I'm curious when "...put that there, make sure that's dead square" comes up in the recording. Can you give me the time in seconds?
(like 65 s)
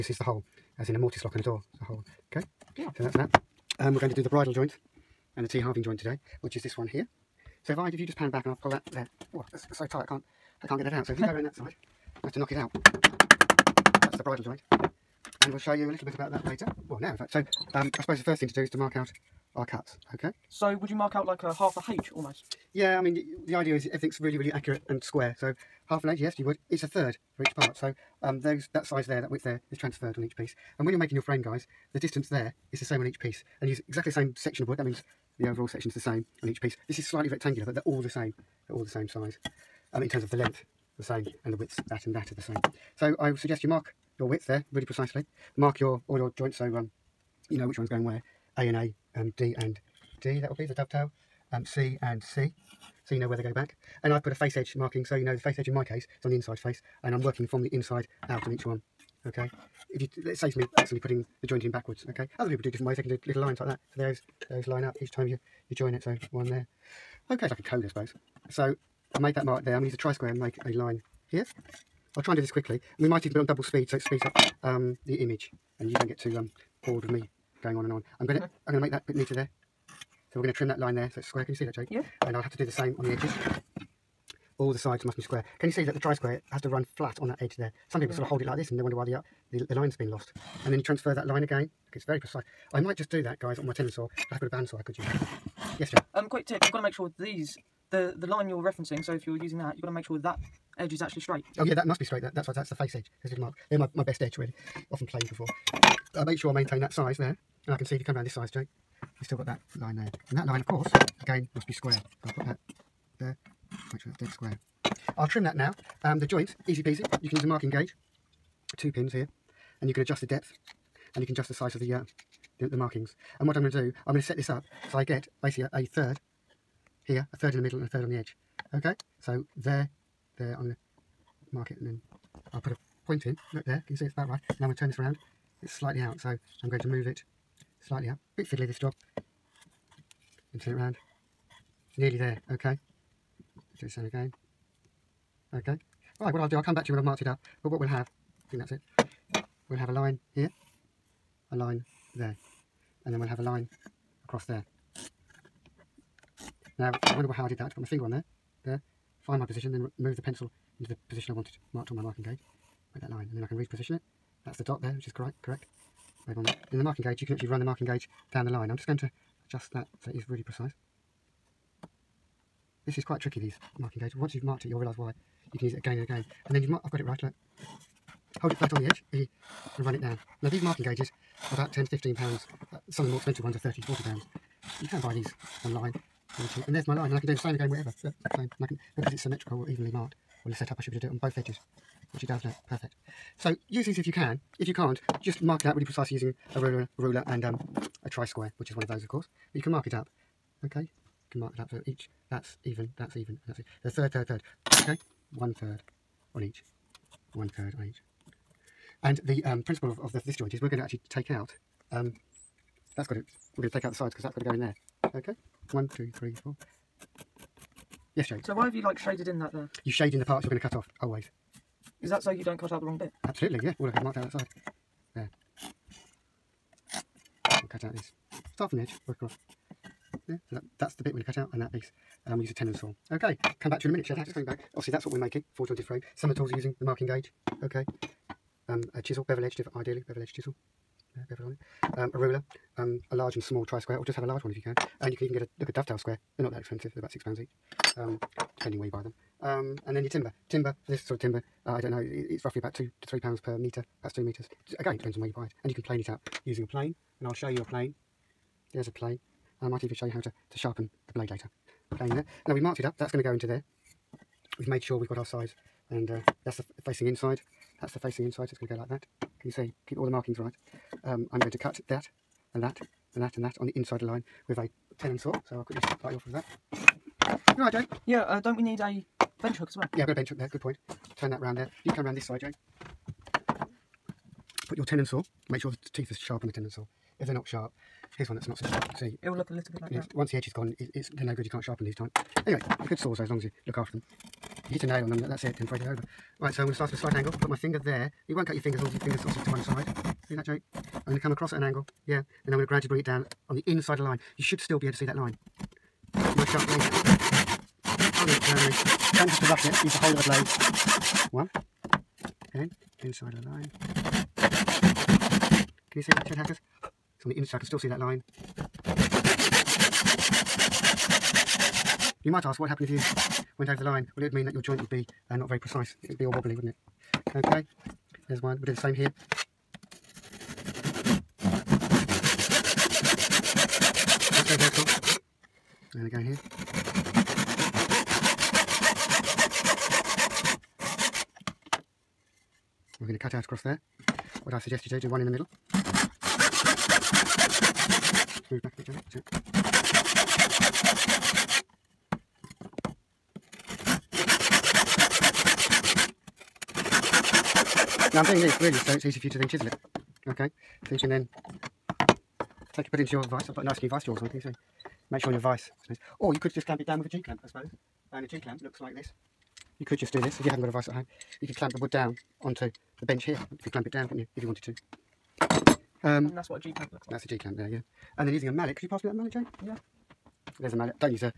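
112 s.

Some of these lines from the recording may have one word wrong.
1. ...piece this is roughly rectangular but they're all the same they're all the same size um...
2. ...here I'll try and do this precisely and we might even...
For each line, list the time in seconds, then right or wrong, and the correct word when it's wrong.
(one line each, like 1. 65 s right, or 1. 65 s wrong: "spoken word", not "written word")
1. 36 s wrong: "slightly", not "roughly"
2. 71 s wrong: "quickly", not "precisely".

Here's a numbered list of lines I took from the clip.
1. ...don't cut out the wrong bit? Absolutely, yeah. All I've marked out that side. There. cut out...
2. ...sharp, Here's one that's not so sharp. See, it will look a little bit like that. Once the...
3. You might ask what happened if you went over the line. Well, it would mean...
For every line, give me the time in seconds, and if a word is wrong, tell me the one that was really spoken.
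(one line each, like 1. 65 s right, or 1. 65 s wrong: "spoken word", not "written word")
1. 222 s right
2. 287 s right
3. 322 s right.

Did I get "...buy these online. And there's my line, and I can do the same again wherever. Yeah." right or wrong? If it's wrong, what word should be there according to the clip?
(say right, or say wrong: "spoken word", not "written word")
right.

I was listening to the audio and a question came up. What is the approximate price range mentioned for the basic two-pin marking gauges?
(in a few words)
10 to 15 pounds.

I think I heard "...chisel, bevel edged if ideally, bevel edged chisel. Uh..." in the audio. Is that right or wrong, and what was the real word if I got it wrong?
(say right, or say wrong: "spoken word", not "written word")
right.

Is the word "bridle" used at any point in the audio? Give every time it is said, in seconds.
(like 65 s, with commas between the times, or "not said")
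4 s, 14 s.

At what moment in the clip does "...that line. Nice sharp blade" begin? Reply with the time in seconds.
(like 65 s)
305 s.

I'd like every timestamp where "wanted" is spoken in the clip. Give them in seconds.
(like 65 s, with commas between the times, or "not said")
161 s, 374 s.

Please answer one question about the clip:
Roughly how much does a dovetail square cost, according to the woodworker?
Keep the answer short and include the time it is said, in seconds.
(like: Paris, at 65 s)
6 pounds, at 247 s.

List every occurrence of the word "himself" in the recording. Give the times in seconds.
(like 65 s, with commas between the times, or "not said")
not said.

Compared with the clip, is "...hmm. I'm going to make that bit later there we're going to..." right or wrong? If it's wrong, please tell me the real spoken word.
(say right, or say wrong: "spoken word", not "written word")
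wrong: "neater", not "later".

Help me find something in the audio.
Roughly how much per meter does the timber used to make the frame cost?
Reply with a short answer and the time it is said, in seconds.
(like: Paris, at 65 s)
2 to 3 pounds, at 252 s.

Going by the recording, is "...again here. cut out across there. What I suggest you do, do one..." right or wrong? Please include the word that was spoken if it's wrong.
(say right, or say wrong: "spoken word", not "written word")
right.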